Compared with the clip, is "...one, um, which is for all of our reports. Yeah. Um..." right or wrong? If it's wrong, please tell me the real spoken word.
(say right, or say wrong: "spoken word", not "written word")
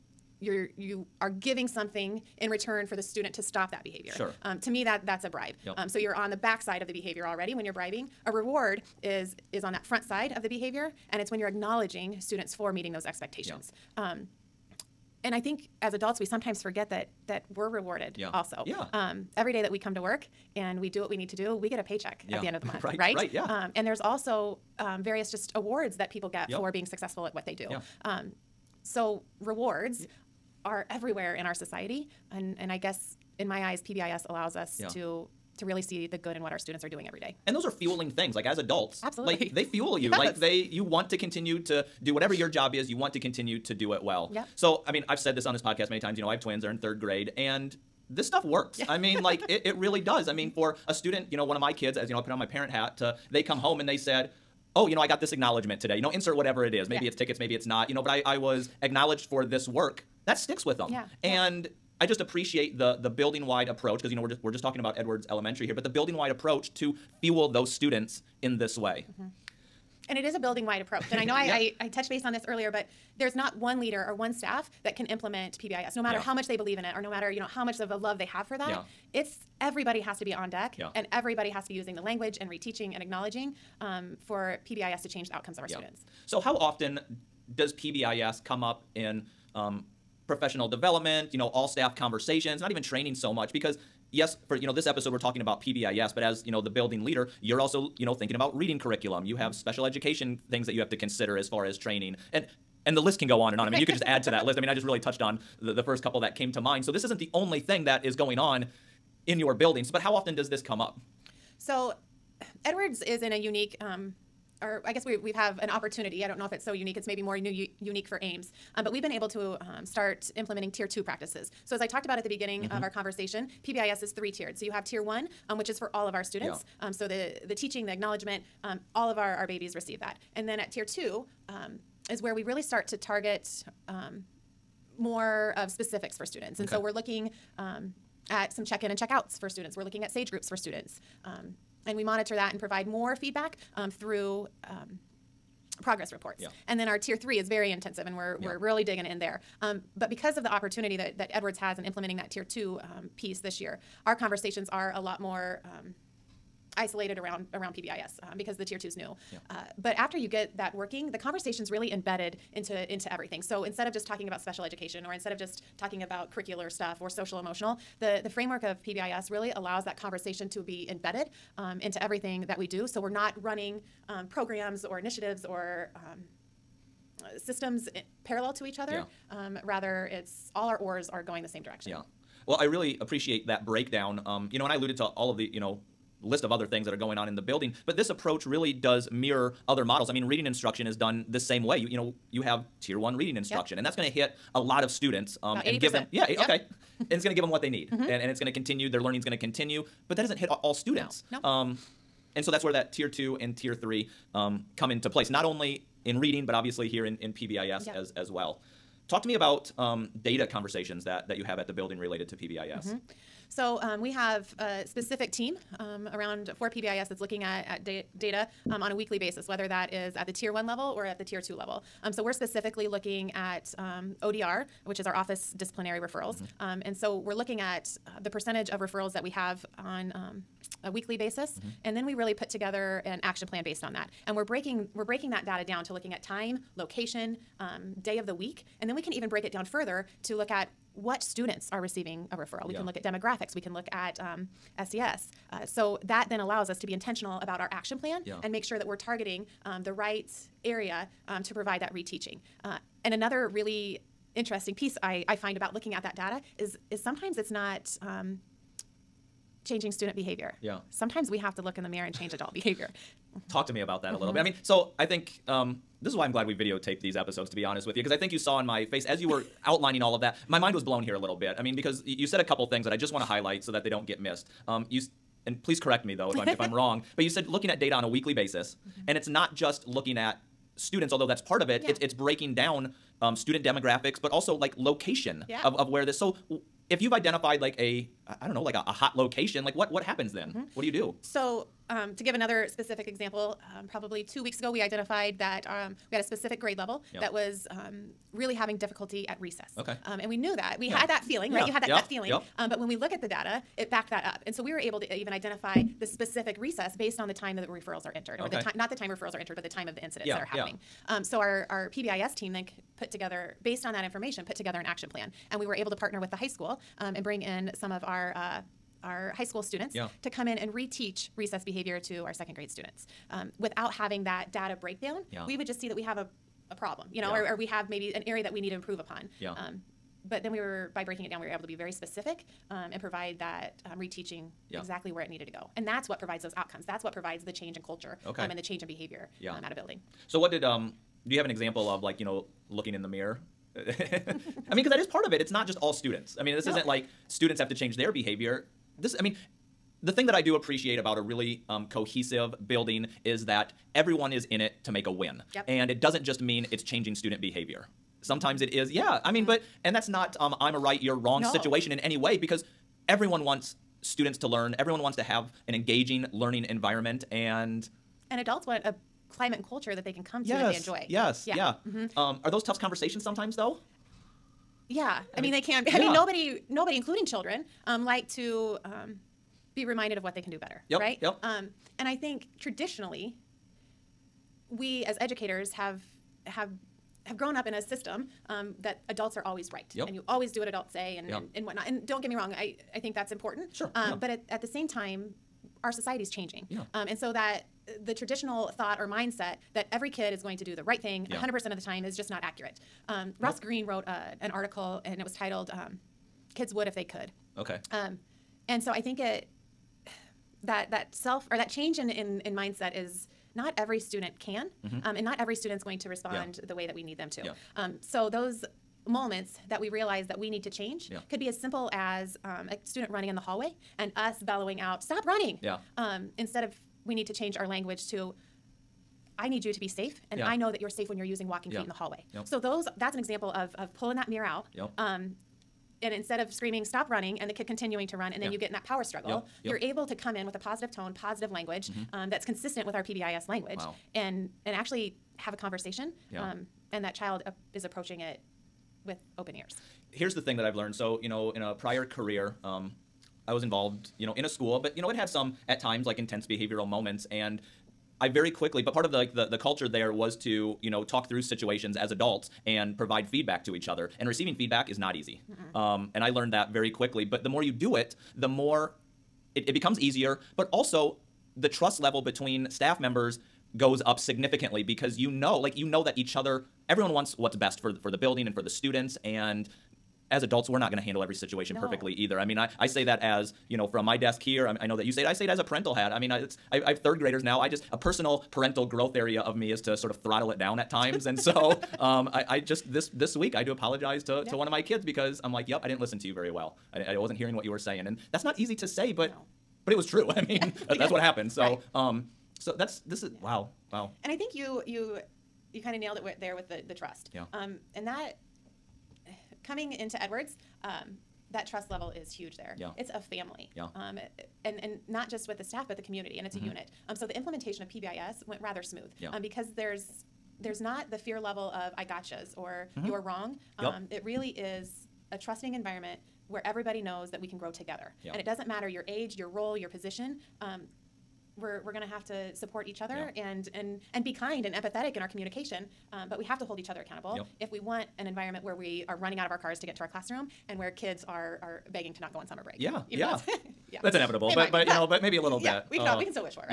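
wrong: "students", not "reports".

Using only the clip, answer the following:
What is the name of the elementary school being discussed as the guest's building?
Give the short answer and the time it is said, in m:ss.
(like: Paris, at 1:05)
Edwards Elementary, at 1:04.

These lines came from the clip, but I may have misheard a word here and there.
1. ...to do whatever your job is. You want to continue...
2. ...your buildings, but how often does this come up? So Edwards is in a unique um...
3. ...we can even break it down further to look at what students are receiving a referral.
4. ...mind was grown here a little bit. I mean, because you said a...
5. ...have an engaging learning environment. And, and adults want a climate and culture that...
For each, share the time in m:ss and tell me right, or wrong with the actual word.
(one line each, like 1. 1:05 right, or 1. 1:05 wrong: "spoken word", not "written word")
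1. 0:41 right
2. 1:49 right
3. 3:58 right
4. 4:30 wrong: "blown", not "grown"
5. 6:05 right.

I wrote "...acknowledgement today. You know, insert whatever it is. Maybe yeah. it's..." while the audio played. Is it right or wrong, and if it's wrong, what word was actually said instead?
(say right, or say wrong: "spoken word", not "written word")
right.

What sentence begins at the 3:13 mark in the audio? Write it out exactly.
and that's going to hit a lot of students um, and give them yeah yep.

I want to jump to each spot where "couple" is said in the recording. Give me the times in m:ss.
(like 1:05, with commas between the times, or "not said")
1:46, 4:32.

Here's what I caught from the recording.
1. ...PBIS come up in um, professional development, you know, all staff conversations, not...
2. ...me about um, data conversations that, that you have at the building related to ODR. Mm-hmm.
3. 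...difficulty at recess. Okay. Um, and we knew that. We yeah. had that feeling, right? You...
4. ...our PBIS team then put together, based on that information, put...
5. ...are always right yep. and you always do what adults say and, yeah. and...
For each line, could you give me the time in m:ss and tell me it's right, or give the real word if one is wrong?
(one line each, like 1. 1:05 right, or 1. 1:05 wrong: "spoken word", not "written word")
1. 1:27 right
2. 3:29 wrong: "PBIS", not "ODR"
3. 4:58 right
4. 5:11 right
5. 6:29 right.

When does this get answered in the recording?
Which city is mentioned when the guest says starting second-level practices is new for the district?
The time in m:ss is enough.
1:58.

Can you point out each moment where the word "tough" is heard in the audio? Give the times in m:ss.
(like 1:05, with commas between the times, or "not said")
6:12.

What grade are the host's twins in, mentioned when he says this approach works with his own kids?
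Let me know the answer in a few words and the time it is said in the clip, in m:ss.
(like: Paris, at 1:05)
Third grade, at 0:46.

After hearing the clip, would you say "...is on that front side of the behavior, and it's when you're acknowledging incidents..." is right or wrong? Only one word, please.
wrong.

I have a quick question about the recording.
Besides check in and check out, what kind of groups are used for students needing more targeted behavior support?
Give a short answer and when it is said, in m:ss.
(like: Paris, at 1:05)
SAGE groups, at 2:20.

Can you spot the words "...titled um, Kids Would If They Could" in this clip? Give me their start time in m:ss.
6:45.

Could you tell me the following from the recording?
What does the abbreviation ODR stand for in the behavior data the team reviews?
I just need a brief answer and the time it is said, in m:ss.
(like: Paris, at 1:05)
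Office disciplinary referrals, at 3:45.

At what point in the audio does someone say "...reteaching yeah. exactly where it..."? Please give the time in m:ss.
5:33.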